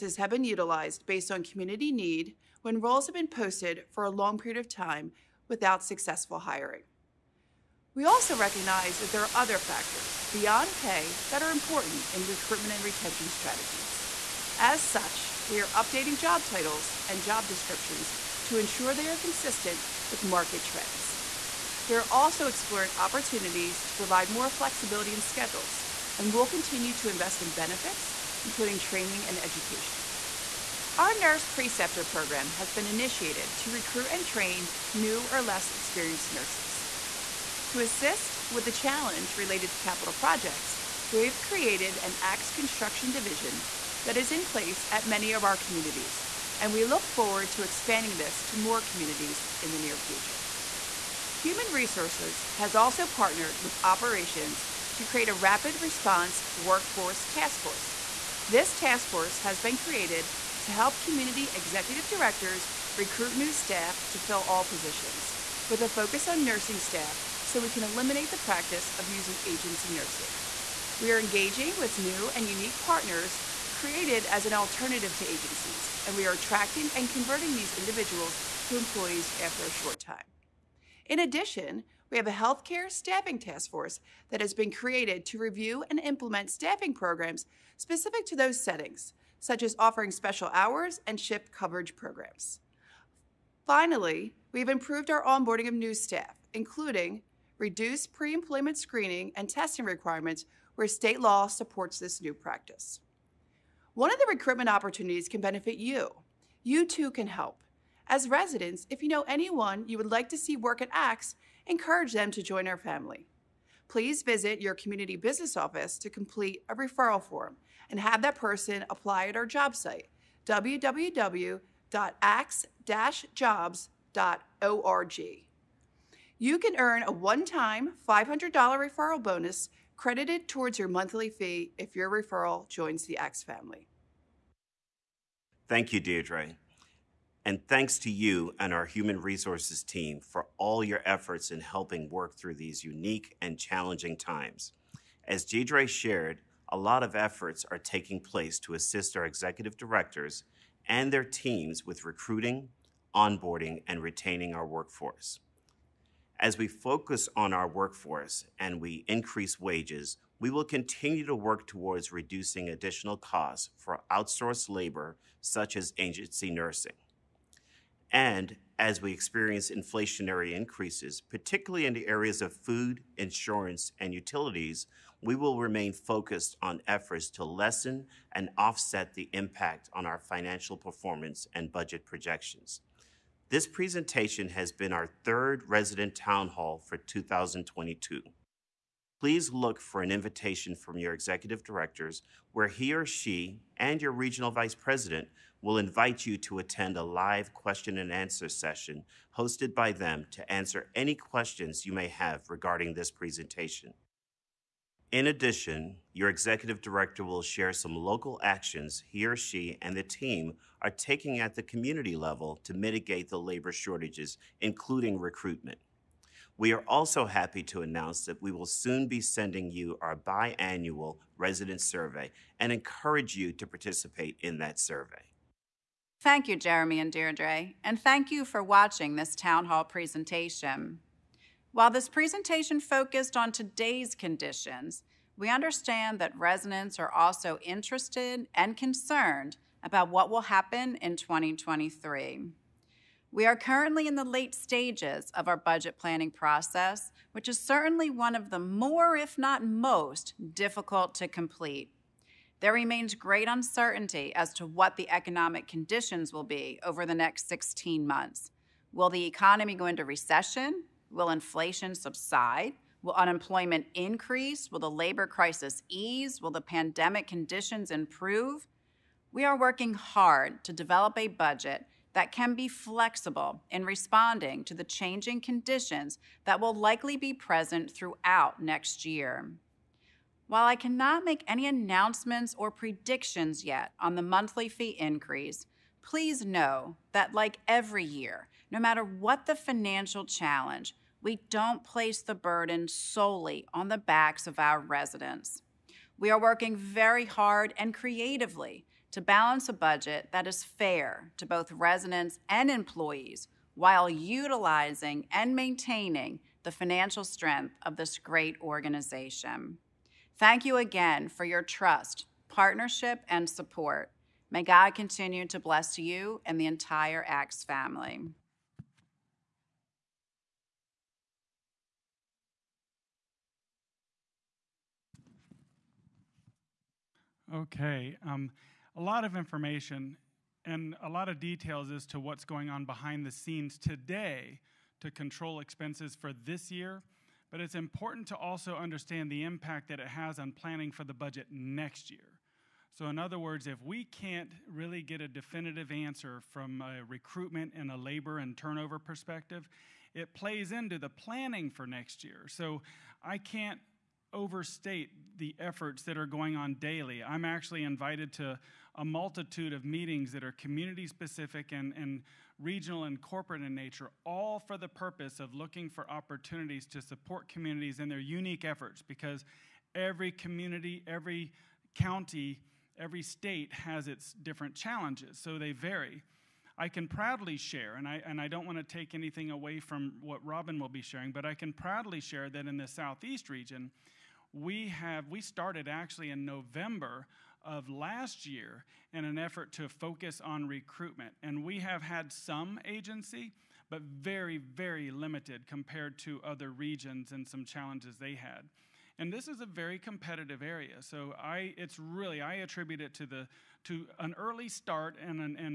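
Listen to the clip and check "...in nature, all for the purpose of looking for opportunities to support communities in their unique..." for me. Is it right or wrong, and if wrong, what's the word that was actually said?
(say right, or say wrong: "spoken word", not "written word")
right.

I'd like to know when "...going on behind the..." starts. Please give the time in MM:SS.
05:32.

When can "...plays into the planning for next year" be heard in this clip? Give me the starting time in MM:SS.
05:50.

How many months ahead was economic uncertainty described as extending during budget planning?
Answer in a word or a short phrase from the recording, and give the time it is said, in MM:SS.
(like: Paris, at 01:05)
16, at 04:17.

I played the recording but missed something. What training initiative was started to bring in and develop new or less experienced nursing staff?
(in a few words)
nurse preceptor program.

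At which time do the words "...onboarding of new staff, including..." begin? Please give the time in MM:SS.
01:35.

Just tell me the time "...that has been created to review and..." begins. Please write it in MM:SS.
01:24.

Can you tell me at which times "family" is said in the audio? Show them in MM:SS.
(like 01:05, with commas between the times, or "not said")
01:52, 02:13, 05:17.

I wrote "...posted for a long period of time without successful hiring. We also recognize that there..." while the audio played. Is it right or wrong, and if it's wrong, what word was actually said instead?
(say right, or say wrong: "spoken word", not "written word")
right.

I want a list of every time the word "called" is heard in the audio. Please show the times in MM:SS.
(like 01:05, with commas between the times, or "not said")
not said.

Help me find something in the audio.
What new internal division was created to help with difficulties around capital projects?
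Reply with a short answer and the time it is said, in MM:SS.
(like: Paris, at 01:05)
ACTS construction division, at 00:42.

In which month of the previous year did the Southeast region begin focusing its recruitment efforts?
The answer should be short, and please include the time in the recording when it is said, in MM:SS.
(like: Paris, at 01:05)
November, at 06:26.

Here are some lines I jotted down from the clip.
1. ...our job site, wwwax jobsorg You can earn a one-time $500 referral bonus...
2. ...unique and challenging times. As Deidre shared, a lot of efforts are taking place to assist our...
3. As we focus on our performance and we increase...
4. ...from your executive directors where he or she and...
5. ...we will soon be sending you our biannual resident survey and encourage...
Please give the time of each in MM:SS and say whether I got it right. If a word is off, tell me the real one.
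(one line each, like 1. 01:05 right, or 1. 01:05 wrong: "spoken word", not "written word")
1. 01:59 right
2. 02:22 right
3. 02:36 wrong: "workforce", not "performance"
4. 03:10 right
5. 03:38 right.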